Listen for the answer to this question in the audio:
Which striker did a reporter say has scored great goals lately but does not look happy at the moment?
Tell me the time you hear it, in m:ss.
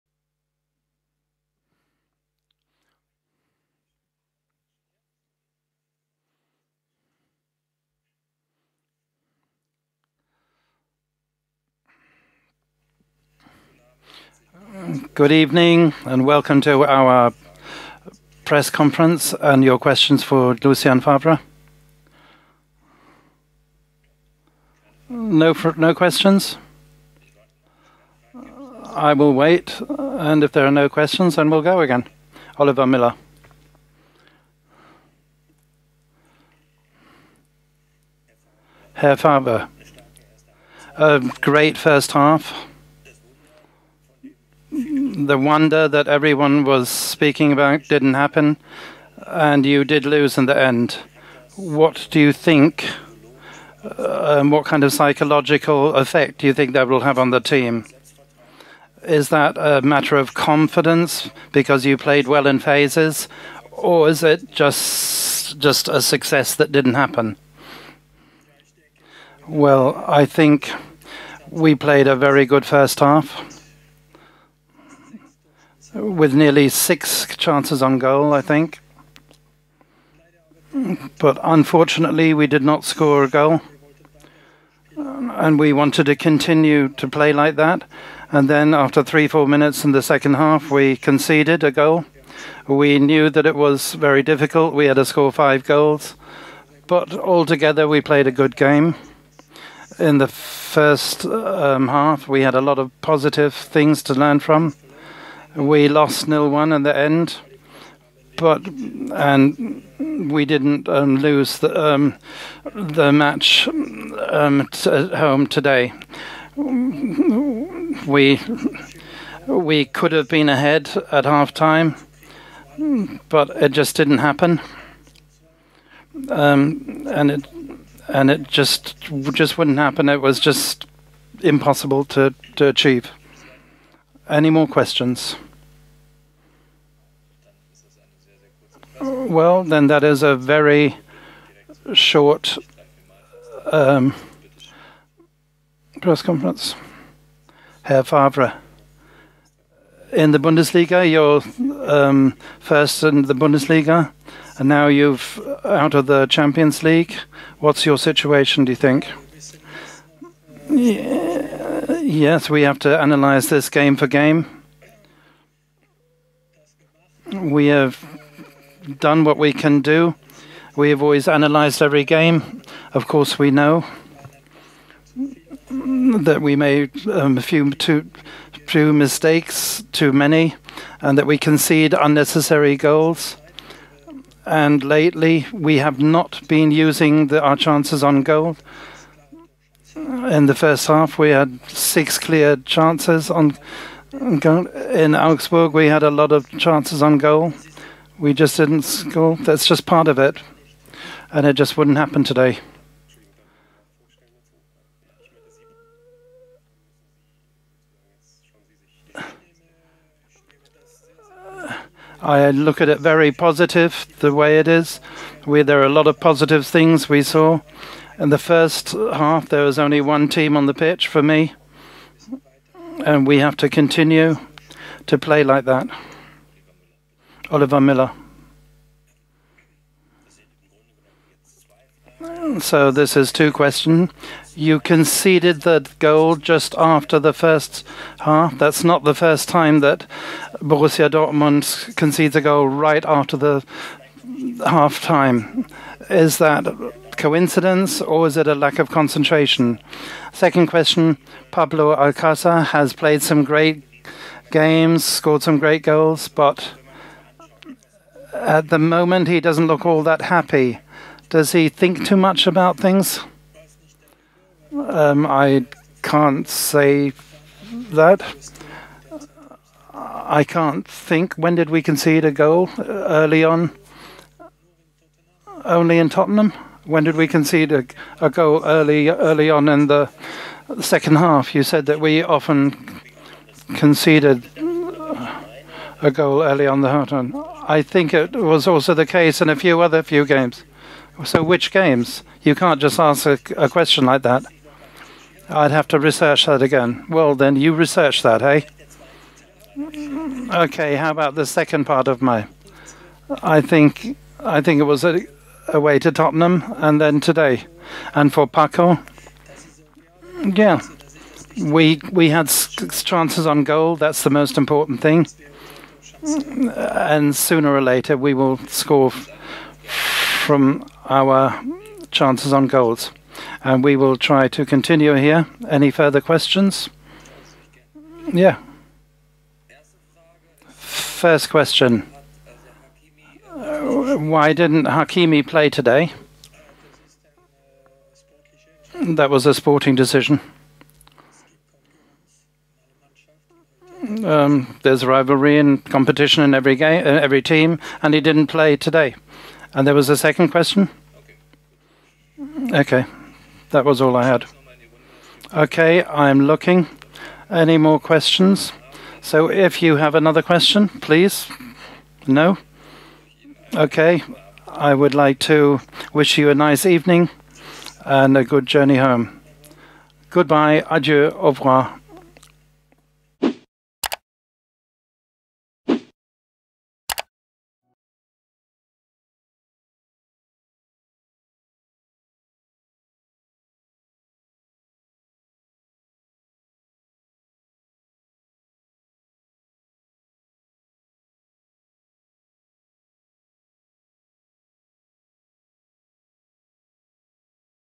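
4:11.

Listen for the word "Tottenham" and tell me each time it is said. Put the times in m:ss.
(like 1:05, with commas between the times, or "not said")
4:36, 5:06.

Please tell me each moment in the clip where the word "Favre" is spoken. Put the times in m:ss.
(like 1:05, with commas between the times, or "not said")
0:20, 0:39, 2:28.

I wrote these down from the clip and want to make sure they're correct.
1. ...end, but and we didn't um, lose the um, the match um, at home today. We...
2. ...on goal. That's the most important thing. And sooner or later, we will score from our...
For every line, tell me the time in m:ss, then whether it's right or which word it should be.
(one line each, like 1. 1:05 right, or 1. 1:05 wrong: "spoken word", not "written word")
1. 1:46 right
2. 5:13 right.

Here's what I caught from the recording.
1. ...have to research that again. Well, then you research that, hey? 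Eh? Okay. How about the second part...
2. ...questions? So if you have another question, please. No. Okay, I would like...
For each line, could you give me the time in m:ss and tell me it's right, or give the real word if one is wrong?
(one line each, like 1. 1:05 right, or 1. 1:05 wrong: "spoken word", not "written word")
1. 4:55 right
2. 5:57 right.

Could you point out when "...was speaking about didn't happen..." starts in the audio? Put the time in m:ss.
0:46.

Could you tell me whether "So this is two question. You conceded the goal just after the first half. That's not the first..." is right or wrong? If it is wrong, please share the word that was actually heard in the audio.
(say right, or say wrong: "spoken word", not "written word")
right.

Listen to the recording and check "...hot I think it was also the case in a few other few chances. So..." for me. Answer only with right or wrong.
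wrong.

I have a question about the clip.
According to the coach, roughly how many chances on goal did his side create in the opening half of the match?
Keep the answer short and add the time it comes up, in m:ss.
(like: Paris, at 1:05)
6, at 1:16.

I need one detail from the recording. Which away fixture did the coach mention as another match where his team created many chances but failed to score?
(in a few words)
Augsburg.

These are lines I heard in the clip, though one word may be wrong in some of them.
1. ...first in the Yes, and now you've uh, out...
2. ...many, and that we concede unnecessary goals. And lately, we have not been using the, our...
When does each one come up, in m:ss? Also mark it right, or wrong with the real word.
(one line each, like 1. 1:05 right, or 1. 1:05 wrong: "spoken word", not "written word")
1. 2:32 wrong: "Bundesliga", not "Yes"
2. 3:00 right.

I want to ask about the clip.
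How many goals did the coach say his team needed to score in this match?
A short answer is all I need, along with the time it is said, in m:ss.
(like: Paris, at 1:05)
5, at 1:34.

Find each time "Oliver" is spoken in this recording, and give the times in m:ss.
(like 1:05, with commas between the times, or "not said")
0:32, 3:47.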